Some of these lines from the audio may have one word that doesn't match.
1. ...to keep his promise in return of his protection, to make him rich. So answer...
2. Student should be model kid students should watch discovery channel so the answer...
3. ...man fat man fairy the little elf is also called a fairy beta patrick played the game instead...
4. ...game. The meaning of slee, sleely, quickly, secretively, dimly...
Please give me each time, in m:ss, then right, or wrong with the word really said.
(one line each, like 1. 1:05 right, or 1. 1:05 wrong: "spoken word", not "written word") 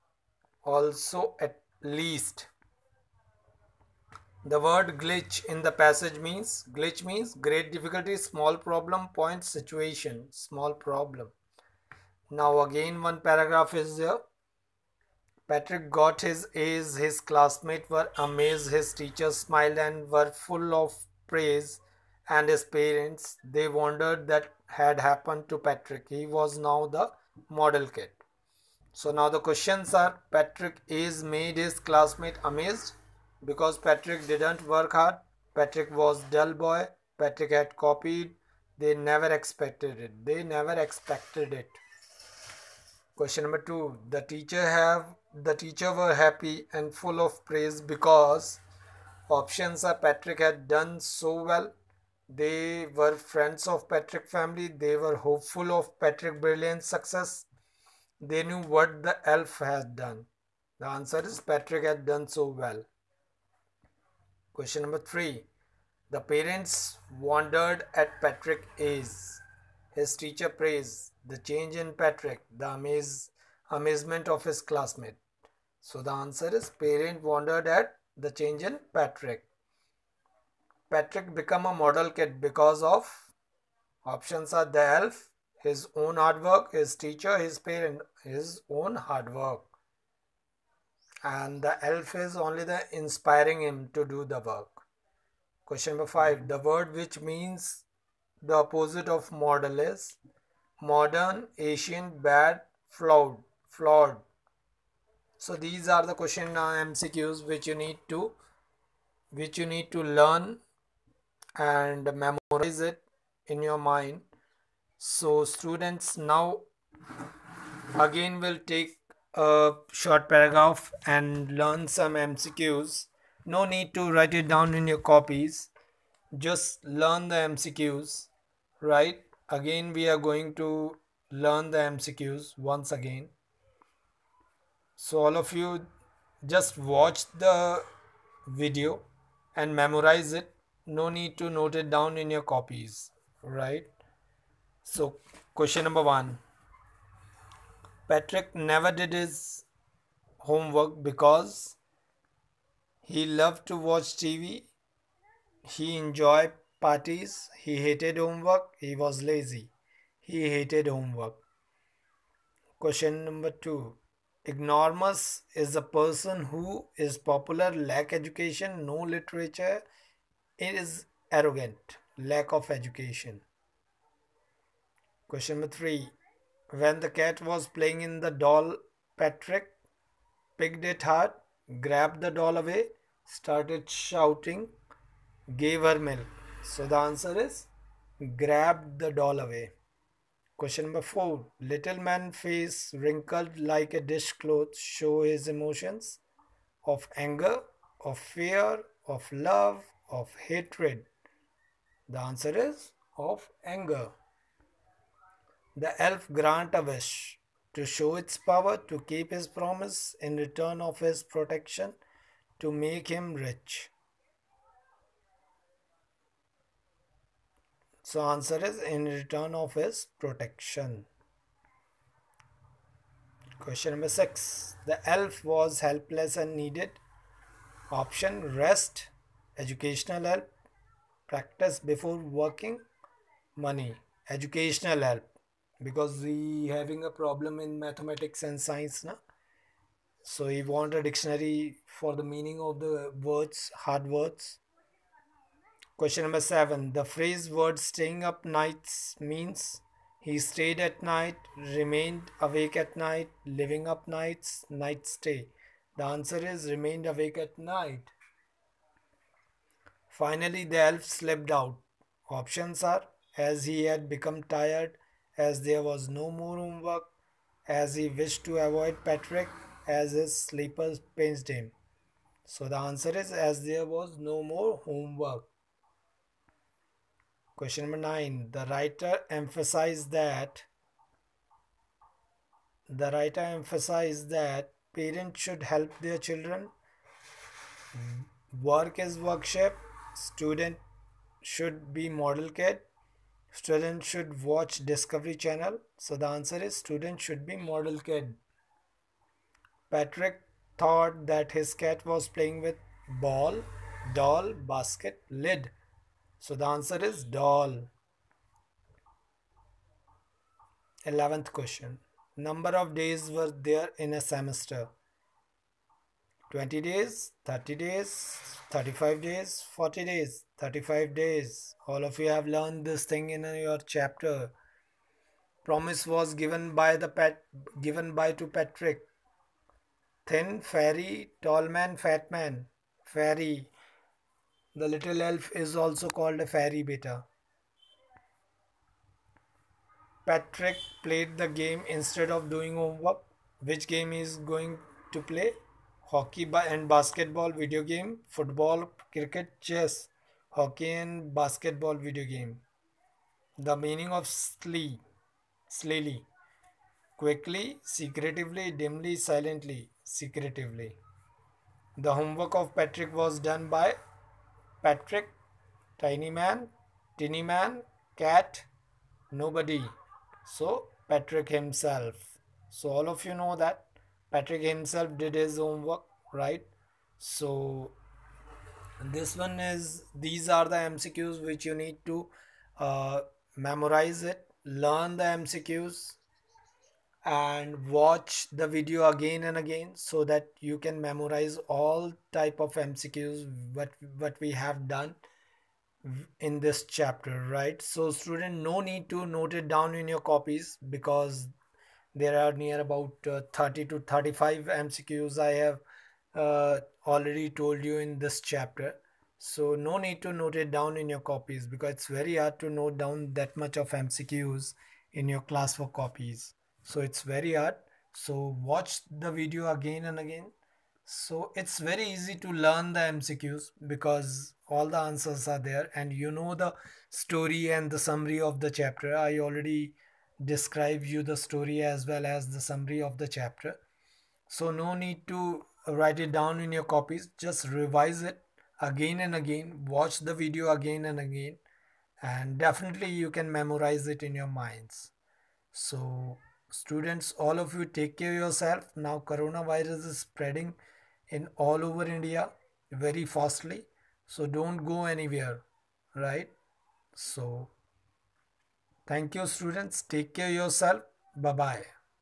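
1. 3:28 right
2. 4:50 right
3. 5:31 right
4. 5:52 right.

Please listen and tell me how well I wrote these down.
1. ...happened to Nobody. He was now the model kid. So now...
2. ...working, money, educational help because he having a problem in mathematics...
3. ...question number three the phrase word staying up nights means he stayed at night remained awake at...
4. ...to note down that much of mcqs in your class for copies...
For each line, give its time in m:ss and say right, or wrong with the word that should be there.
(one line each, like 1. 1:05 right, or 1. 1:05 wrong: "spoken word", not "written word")
1. 0:25 wrong: "Patrick", not "Nobody"
2. 3:52 right
3. 4:05 wrong: "seven", not "three"
4. 6:52 right.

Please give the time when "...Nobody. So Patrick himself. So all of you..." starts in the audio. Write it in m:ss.
6:09.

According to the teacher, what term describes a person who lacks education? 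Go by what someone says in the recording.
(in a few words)
Ignoramus.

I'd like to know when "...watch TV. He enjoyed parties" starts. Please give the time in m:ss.
2:33.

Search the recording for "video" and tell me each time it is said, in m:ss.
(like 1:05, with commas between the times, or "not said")
2:18, 5:47, 5:51, 6:28, 6:59, 7:20.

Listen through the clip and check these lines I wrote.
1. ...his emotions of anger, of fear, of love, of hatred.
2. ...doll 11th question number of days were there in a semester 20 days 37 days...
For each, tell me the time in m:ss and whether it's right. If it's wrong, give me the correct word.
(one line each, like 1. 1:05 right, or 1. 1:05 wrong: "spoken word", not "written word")
1. 3:15 right
2. 5:07 wrong: "30", not "37".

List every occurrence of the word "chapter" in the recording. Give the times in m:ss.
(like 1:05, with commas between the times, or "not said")
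5:23, 6:36, 6:48, 7:08, 7:13.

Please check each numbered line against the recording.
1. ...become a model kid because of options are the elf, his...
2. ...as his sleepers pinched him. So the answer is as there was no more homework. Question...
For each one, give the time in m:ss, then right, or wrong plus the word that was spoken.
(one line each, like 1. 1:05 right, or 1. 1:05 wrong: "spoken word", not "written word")
1. 1:21 right
2. 4:29 right.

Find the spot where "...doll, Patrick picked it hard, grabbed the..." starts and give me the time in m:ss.
2:58.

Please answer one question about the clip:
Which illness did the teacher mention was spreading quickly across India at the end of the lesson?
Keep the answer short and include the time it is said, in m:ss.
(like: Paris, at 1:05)
Coronavirus, at 7:29.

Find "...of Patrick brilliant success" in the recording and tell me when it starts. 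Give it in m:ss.
0:55.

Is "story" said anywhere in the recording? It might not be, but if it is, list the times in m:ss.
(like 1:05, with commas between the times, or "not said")
7:07, 7:11.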